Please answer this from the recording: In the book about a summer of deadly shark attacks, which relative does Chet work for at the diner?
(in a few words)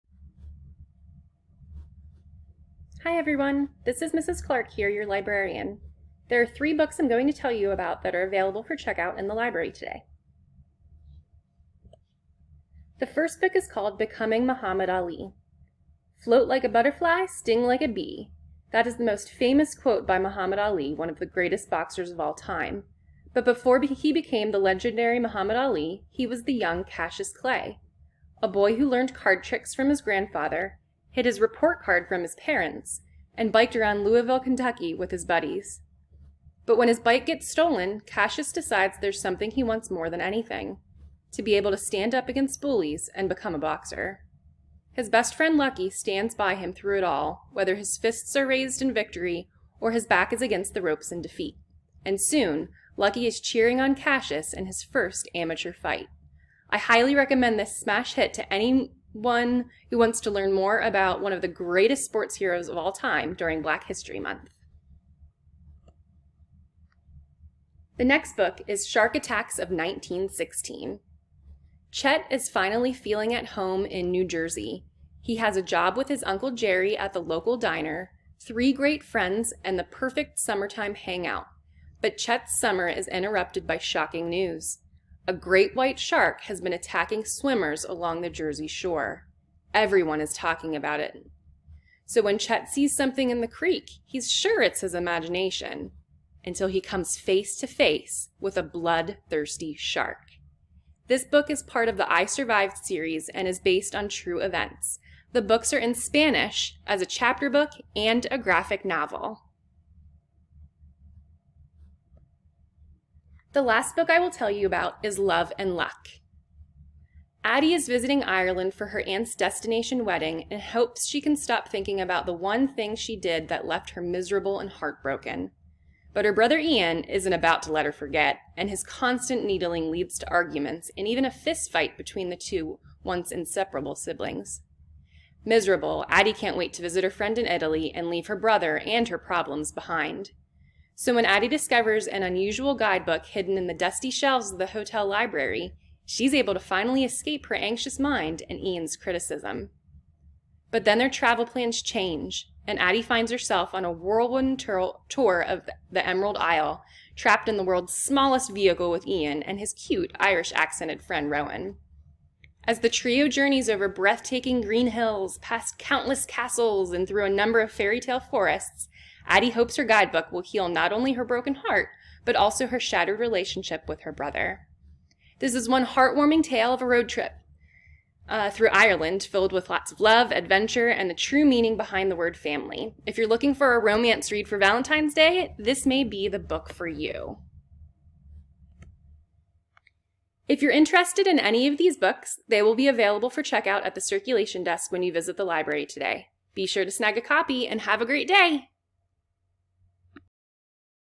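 Uncle Jerry.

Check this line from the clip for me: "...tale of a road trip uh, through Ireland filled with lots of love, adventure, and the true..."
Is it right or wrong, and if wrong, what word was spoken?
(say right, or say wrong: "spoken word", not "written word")
right.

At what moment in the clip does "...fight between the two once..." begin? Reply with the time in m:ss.
2:11.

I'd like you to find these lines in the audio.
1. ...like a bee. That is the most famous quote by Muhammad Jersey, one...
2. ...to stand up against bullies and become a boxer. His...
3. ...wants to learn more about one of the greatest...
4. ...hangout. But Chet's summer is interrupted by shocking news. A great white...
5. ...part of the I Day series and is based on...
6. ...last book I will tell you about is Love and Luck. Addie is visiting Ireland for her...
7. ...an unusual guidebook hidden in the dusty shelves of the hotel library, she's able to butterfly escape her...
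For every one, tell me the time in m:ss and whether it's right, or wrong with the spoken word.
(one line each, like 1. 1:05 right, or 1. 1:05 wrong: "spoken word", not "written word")
1. 0:17 wrong: "Ali", not "Jersey"
2. 0:41 right
3. 0:59 right
4. 1:20 right
5. 1:41 wrong: "Survived", not "Day"
6. 1:53 right
7. 2:22 wrong: "finally", not "butterfly".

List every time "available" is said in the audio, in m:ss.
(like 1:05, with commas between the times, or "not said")
0:08, 3:12.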